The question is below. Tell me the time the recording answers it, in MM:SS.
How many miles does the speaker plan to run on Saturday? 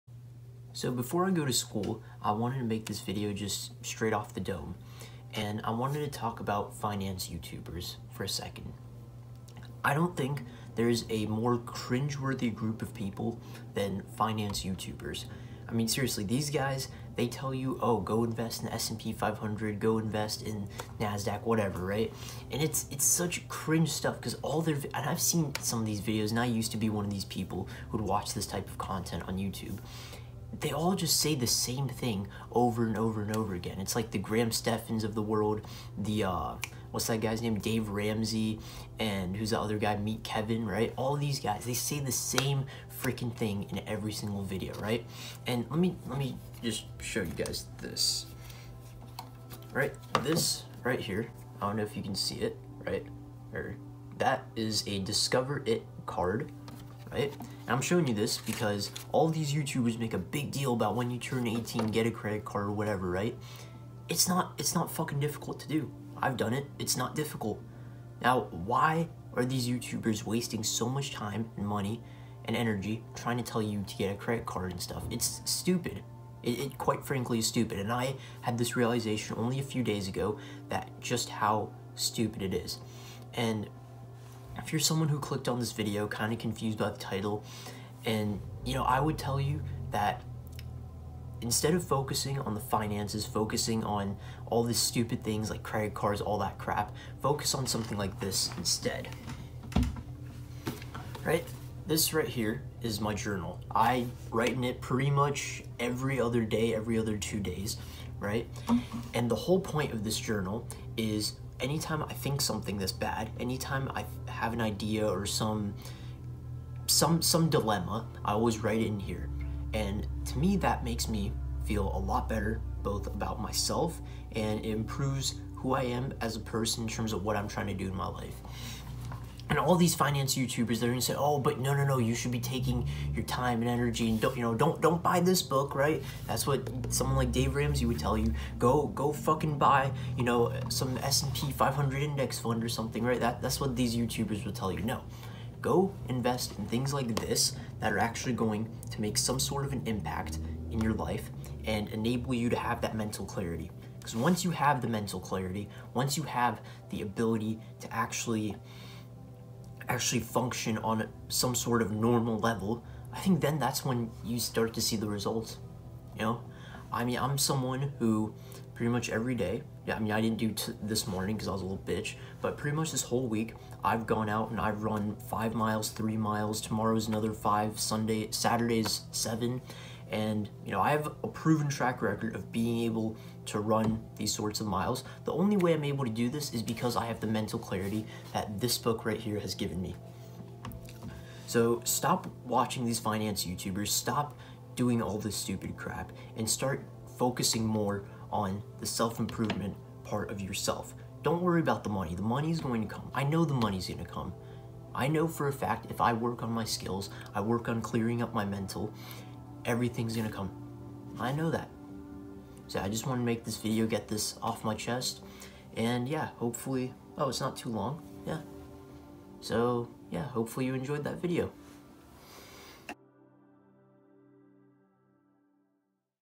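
02:59.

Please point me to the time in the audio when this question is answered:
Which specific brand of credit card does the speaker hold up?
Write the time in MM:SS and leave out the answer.
00:54.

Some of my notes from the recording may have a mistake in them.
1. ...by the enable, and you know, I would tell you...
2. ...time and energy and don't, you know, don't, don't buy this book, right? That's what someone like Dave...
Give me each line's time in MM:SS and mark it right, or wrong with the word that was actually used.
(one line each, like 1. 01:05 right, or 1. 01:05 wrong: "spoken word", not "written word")
1. 01:26 wrong: "title", not "enable"
2. 02:13 right.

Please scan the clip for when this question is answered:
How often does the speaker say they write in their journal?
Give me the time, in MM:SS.
01:45.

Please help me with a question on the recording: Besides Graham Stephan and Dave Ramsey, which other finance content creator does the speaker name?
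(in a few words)
Meet Kevin.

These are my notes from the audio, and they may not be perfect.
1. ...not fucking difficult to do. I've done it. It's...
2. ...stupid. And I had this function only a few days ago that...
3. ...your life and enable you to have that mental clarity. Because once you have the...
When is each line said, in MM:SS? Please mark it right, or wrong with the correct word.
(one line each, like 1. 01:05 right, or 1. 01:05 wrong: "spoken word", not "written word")
1. 01:04 right
2. 01:17 wrong: "realization", not "function"
3. 02:30 right.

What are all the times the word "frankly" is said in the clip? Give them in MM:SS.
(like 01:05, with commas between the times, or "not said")
01:17.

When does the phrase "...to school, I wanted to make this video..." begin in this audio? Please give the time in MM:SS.
00:01.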